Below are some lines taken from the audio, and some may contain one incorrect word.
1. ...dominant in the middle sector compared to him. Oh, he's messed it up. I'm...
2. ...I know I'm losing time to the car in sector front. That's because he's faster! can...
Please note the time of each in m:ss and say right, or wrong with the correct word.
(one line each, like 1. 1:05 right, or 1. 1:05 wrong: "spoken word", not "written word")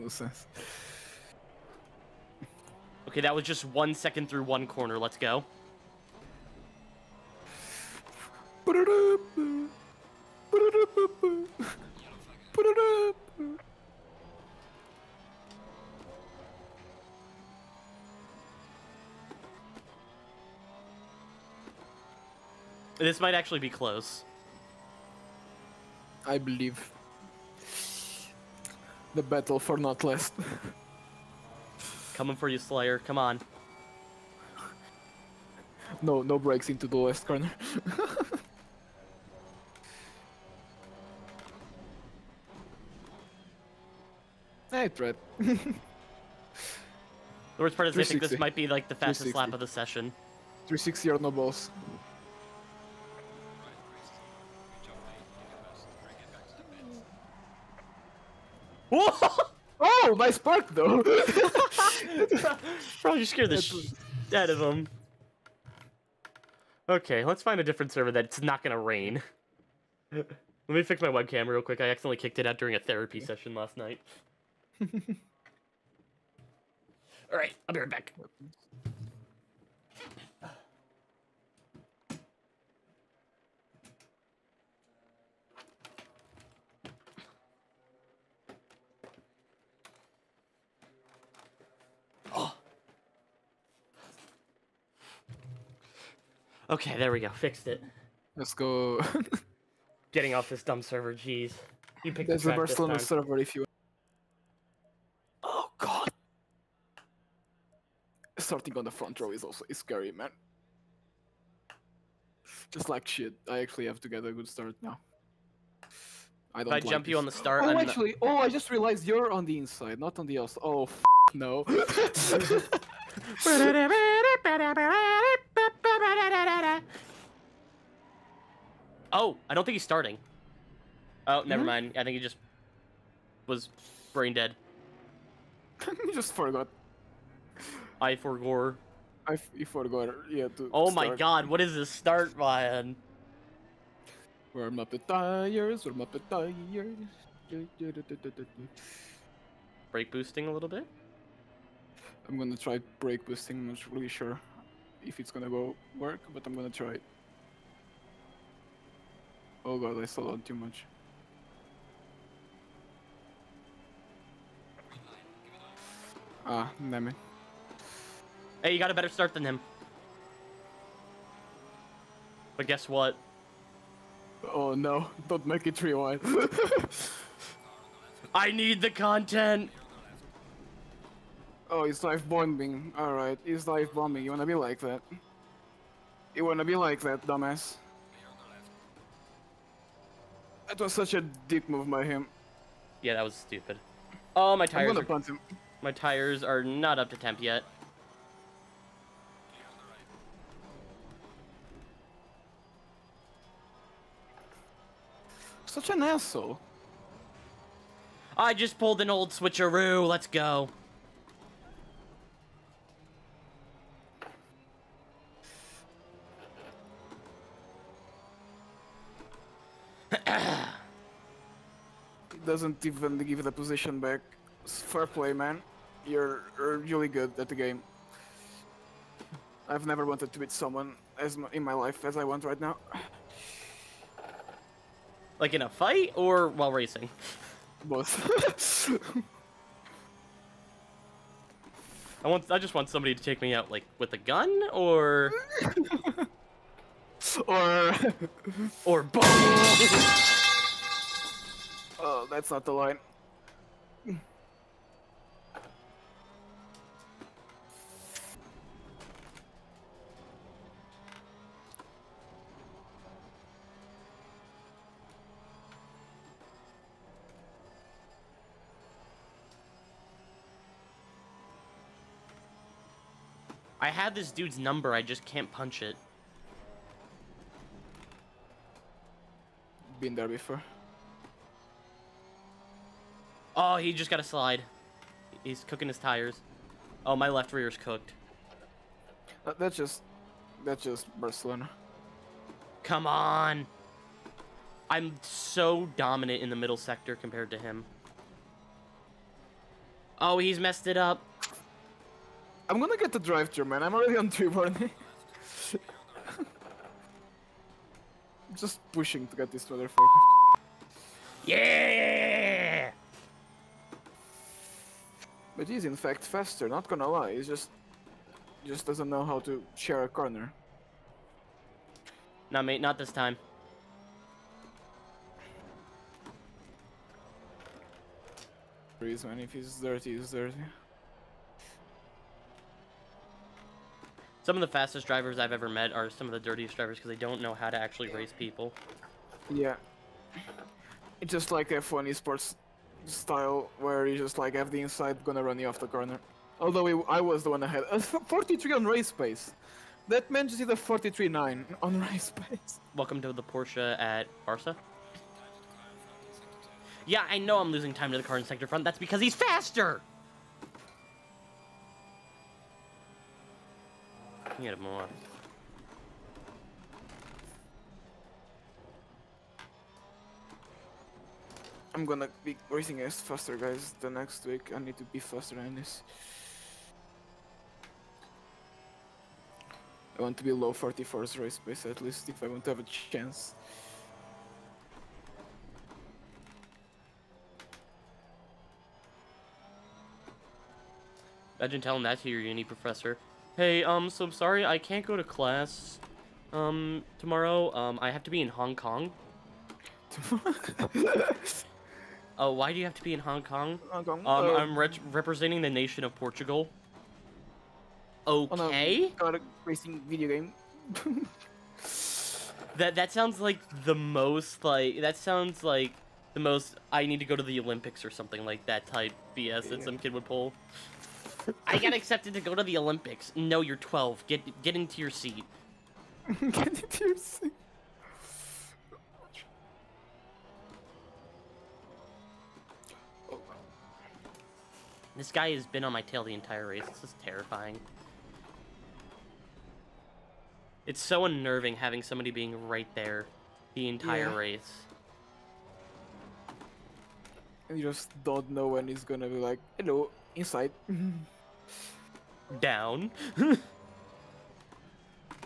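1. 4:55 right
2. 5:57 right.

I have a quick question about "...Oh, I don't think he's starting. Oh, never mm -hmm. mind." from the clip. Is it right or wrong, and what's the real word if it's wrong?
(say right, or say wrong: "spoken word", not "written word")
right.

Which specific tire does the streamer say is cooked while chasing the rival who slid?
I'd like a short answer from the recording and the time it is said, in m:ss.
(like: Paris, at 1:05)
left rear, at 4:47.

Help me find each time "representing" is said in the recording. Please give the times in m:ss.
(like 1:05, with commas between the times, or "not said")
6:45.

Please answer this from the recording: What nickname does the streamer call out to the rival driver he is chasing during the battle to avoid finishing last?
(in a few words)
Slayer.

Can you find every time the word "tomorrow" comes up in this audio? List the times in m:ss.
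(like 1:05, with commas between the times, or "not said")
6:37.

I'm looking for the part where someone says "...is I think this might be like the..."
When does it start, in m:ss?
0:47.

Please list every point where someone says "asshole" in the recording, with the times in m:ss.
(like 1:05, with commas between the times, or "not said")
3:26.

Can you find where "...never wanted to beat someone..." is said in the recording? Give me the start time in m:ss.
3:49.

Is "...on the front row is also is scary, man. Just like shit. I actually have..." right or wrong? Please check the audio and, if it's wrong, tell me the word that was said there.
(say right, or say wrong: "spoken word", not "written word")
right.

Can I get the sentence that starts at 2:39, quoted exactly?
Oh god, I slowed down too much.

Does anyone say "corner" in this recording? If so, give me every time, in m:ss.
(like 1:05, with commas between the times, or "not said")
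0:04, 0:37, 5:20, 5:45.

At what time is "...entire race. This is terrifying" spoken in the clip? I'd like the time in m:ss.
7:16.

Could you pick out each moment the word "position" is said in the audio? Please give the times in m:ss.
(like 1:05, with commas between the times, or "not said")
3:43.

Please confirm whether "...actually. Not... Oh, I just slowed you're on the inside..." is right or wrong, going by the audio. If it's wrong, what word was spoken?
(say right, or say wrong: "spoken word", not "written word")
wrong: "realized", not "slowed".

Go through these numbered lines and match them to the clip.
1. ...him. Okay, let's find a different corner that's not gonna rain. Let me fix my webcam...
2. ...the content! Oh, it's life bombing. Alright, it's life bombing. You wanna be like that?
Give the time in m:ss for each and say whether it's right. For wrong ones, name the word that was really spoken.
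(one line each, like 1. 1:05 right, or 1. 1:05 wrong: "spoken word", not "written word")
1. 1:04 wrong: "server", not "corner"
2. 2:58 right.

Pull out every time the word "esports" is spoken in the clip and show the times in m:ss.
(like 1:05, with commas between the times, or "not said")
5:42.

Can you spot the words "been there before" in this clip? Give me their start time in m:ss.
4:40.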